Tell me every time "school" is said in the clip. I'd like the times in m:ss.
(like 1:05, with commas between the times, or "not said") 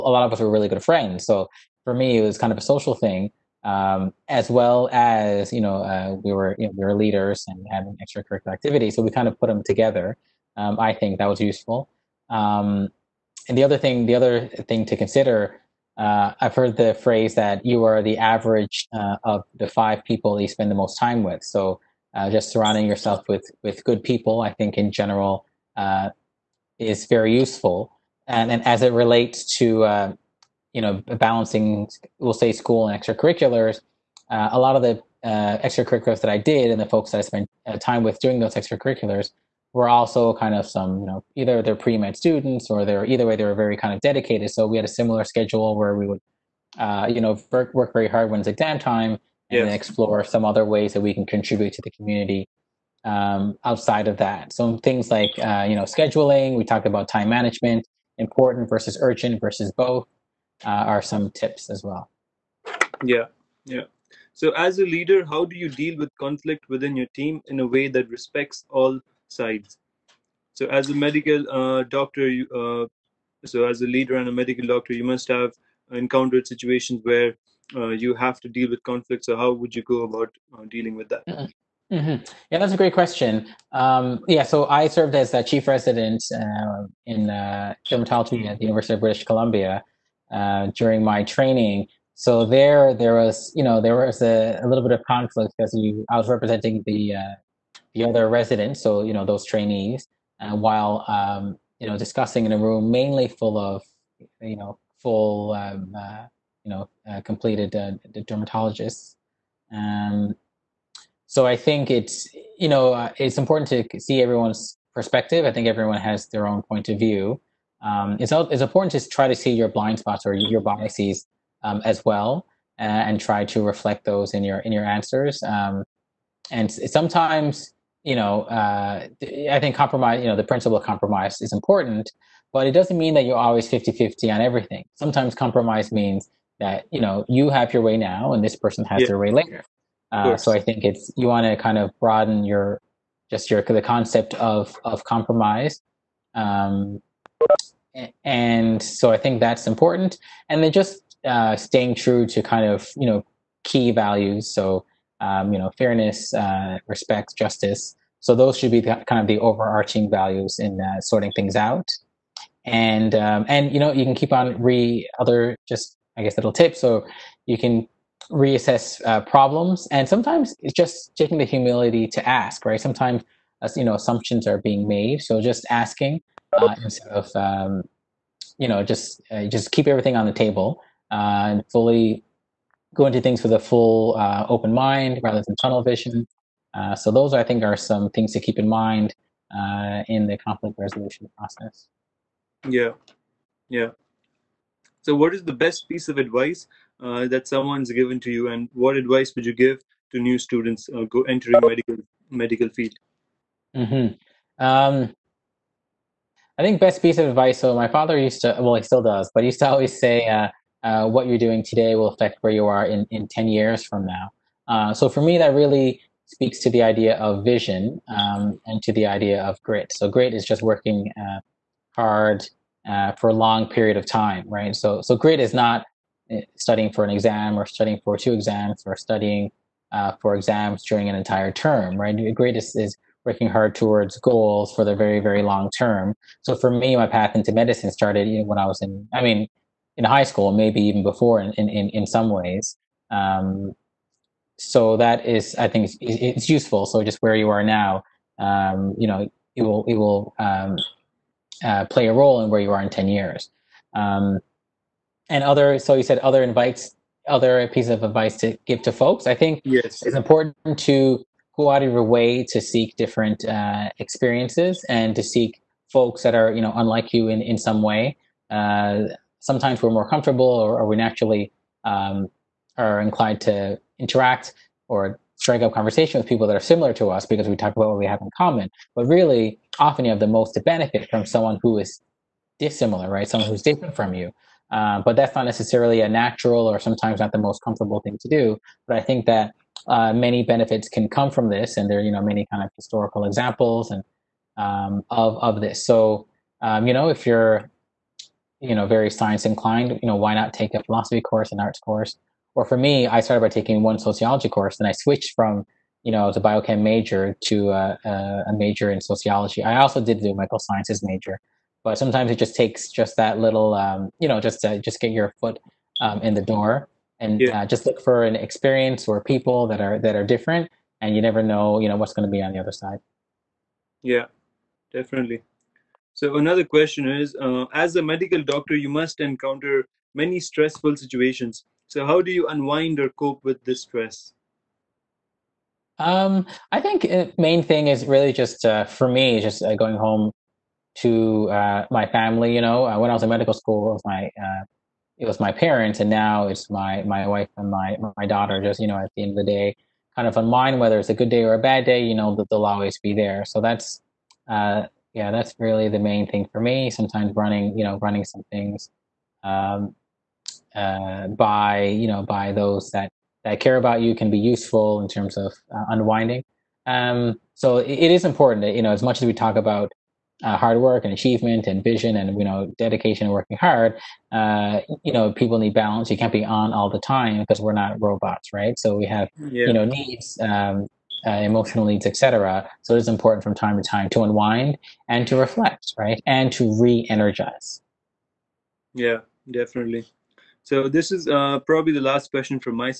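0:32, 4:00, 5:43.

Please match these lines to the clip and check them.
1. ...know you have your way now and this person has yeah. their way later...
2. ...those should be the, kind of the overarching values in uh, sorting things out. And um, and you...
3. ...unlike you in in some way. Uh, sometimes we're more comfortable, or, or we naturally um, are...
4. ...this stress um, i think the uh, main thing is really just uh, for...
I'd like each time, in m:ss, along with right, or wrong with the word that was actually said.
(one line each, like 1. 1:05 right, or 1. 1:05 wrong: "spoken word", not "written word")
1. 2:16 right
2. 2:38 right
3. 4:26 right
4. 5:33 right.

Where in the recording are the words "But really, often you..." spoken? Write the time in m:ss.
4:38.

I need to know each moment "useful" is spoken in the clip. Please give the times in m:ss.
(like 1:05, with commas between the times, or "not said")
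0:11, 0:27, 4:06, 6:04.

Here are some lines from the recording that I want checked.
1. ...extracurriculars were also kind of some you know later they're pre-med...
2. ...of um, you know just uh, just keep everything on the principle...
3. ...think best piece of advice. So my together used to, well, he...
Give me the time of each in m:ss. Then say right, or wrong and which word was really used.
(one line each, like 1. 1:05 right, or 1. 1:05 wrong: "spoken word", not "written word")
1. 0:38 wrong: "either", not "later"
2. 2:57 wrong: "table", not "principle"
3. 3:26 wrong: "father", not "together".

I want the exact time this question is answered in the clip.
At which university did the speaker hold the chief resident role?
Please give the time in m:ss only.
1:28.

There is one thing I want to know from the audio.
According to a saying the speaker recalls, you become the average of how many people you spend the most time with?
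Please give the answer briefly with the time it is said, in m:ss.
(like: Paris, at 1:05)
5, at 0:19.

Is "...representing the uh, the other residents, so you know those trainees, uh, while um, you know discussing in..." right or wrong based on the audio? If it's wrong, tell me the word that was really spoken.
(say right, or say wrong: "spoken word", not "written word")
right.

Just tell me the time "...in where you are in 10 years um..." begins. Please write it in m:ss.
4:12.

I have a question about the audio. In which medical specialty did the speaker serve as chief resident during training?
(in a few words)
Dermatology.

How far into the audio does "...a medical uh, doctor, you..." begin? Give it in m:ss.
1:10.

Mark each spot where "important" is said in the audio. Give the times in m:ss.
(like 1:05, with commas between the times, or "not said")
0:58, 1:53, 1:58, 2:11, 2:29, 4:20, 6:08, 6:23.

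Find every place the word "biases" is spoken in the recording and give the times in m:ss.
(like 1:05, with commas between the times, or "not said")
2:00.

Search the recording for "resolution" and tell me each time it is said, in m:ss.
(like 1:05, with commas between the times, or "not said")
3:10.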